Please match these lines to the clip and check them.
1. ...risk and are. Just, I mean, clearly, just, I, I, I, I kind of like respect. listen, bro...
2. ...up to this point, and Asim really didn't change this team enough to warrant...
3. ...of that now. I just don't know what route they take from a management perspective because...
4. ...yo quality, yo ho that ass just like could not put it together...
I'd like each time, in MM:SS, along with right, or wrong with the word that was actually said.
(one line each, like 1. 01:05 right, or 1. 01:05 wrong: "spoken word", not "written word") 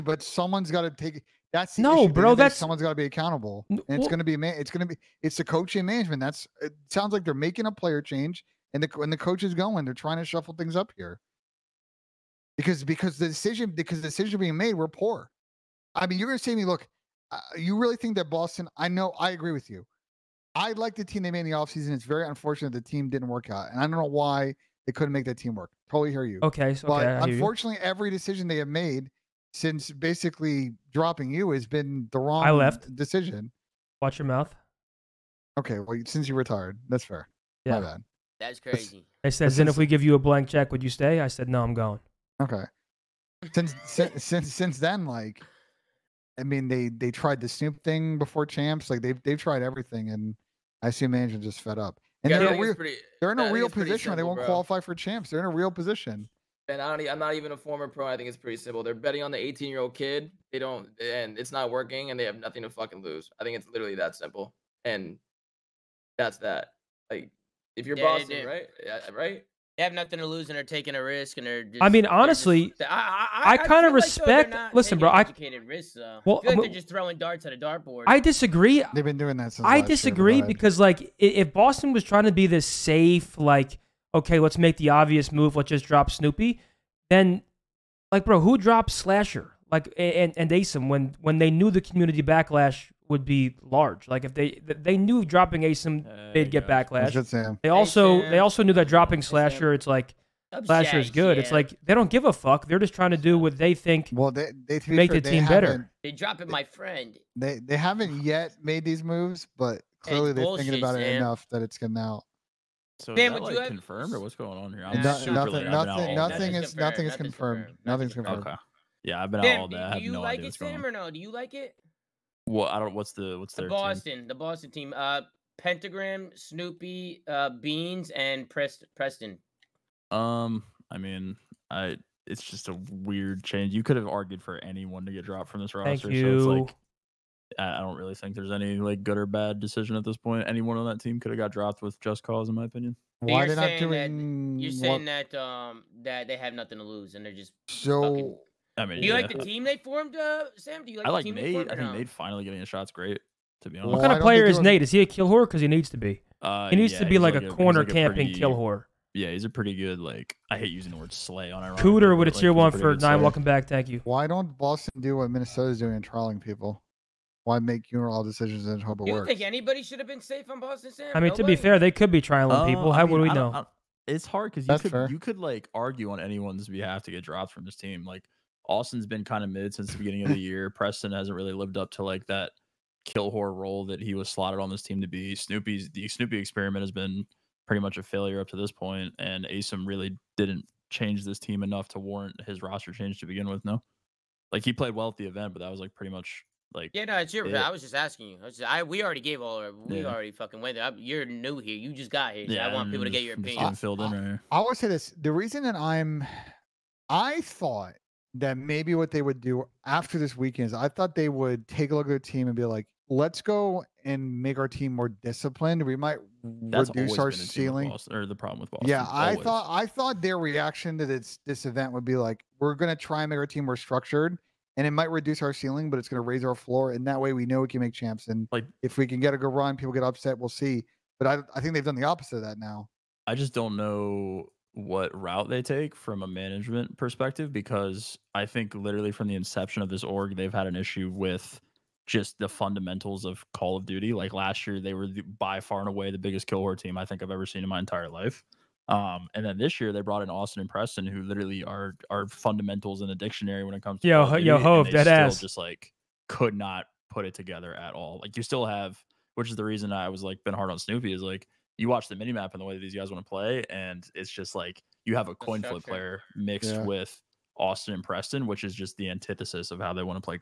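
1. 01:11 wrong: "honestly", not "clearly"
2. 03:08 right
3. 03:52 right
4. 04:14 right.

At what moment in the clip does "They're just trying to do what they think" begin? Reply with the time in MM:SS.
01:42.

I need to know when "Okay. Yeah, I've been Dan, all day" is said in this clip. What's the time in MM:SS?
01:58.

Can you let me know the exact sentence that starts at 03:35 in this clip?
We might That's reduce our ceiling Boston, or the problem with Boston.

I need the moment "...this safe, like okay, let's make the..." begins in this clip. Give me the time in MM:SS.
01:22.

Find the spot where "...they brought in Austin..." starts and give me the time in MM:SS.
04:09.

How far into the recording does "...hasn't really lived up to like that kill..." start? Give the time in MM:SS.
03:01.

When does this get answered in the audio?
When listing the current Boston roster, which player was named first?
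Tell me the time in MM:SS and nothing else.
02:05.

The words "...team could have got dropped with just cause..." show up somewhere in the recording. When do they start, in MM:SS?
02:21.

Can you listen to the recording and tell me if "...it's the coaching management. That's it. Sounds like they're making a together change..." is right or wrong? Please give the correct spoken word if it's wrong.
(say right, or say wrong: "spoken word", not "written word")
wrong: "player", not "together".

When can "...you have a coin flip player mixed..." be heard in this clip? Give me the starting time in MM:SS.
04:25.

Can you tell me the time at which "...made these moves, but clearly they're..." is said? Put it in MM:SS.
01:48.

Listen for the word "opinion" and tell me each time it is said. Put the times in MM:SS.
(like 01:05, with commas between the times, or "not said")
02:22, 03:23.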